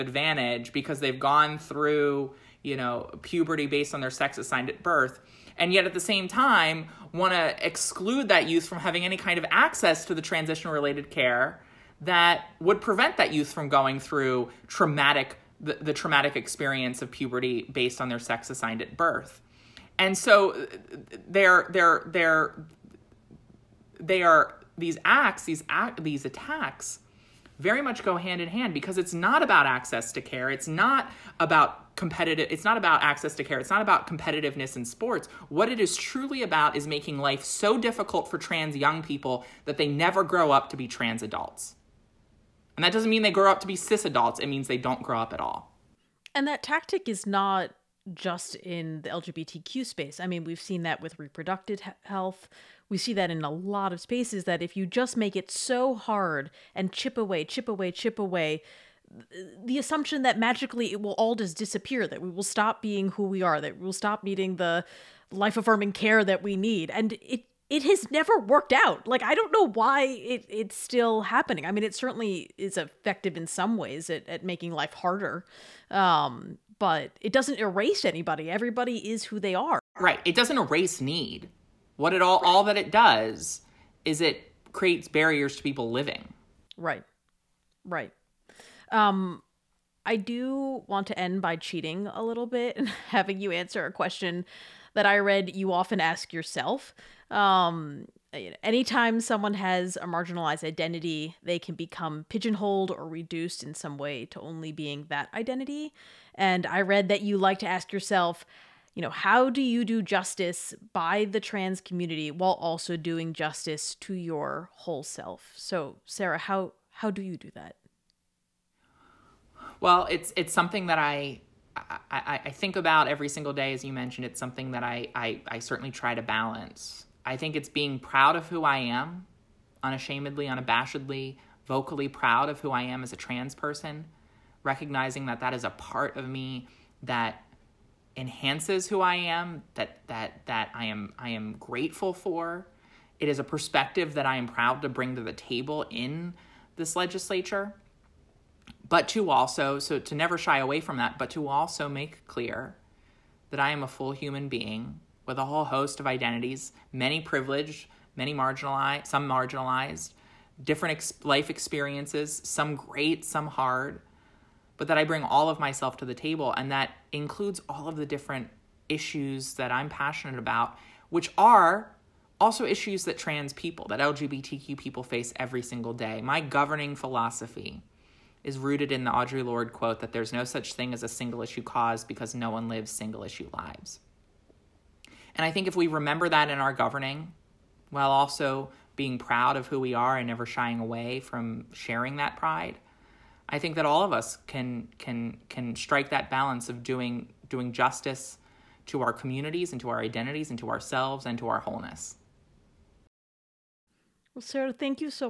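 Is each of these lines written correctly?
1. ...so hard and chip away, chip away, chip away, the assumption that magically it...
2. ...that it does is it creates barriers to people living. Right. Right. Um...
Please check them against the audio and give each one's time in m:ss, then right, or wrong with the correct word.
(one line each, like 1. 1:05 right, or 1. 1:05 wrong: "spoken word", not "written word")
1. 0:55 right
2. 1:22 right.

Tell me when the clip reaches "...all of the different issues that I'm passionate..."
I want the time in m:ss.
2:47.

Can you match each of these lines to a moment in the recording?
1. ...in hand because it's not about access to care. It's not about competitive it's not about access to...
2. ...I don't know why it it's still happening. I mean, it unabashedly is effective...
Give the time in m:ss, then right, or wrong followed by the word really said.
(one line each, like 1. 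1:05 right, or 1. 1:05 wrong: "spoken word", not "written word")
1. 0:28 right
2. 1:09 wrong: "certainly", not "unabashedly".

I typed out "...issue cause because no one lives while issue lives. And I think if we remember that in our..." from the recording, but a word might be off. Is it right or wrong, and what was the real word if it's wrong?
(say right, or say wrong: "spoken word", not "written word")
wrong: "single", not "while".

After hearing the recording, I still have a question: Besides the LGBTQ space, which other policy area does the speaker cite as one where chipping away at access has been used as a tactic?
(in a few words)
Reproductive health.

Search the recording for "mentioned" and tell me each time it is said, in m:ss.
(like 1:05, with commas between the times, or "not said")
2:03.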